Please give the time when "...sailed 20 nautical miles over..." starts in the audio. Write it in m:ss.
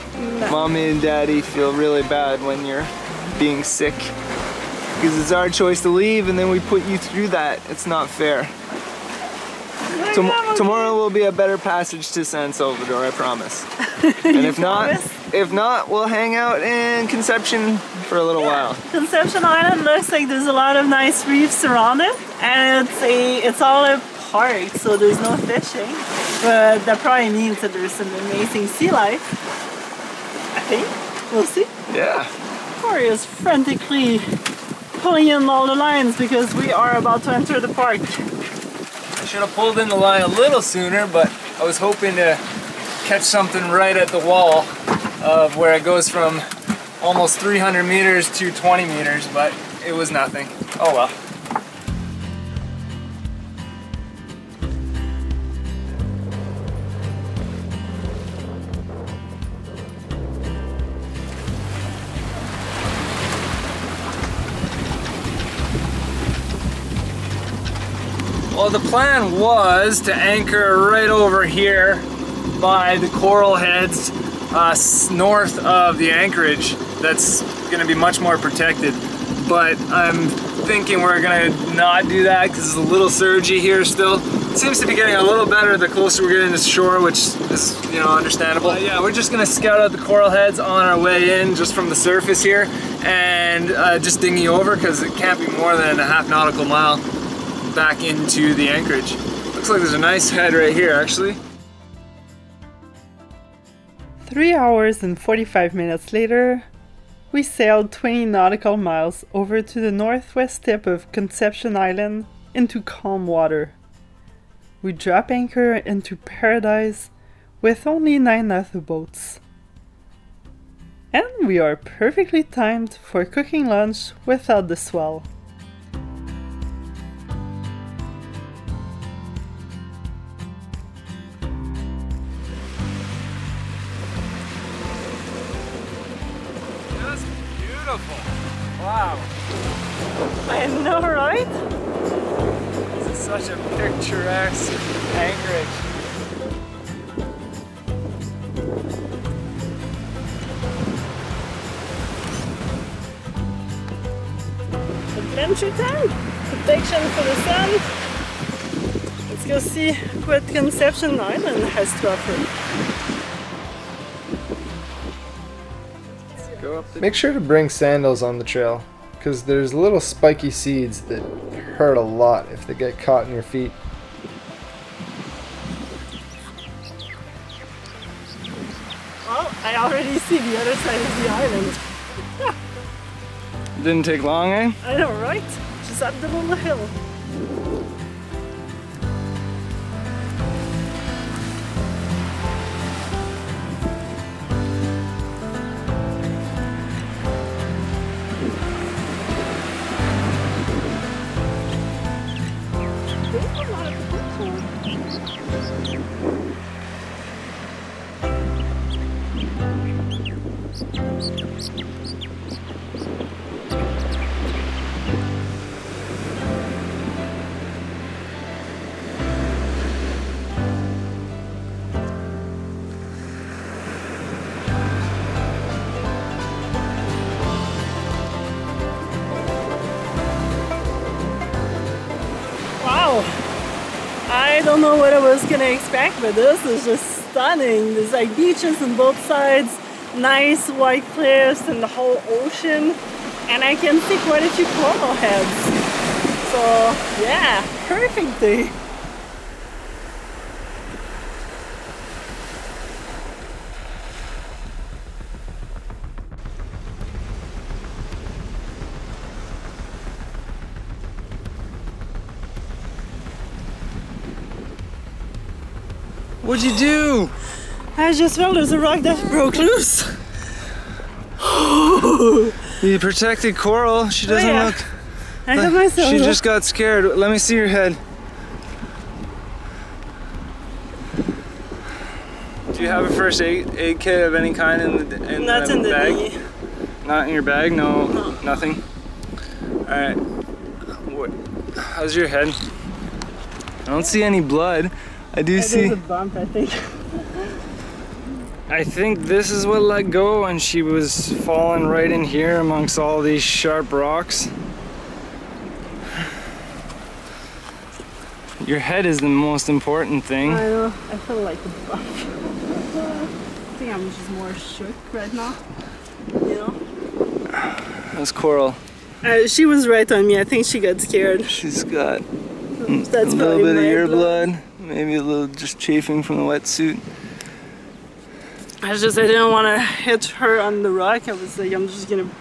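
1:47.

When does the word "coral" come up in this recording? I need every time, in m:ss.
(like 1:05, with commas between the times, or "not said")
1:13, 1:29, 4:04, 4:33, 5:18.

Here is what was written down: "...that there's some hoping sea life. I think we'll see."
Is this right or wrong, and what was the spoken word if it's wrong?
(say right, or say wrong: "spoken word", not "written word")
wrong: "amazing", not "hoping".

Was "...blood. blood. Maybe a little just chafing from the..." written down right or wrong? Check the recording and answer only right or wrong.
right.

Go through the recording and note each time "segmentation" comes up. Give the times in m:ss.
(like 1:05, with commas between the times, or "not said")
not said.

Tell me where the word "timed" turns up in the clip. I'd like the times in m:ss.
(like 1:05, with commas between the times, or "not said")
2:02.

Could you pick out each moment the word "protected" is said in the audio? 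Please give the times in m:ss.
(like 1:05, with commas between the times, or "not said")
1:18, 4:32.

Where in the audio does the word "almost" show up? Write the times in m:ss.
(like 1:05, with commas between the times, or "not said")
0:47.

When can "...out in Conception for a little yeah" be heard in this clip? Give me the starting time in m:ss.
0:16.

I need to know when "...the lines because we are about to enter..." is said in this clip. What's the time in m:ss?
0:35.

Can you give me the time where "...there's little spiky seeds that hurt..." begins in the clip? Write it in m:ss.
2:49.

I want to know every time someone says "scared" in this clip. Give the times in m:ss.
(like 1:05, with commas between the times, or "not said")
4:36, 5:20.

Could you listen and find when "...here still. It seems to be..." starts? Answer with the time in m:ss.
1:23.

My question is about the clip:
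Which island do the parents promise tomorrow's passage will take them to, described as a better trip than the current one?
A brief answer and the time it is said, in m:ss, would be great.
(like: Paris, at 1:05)
San Salvador, at 0:12.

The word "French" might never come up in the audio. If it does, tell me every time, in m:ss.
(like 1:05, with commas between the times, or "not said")
not said.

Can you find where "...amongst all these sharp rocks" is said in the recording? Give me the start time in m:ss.
5:02.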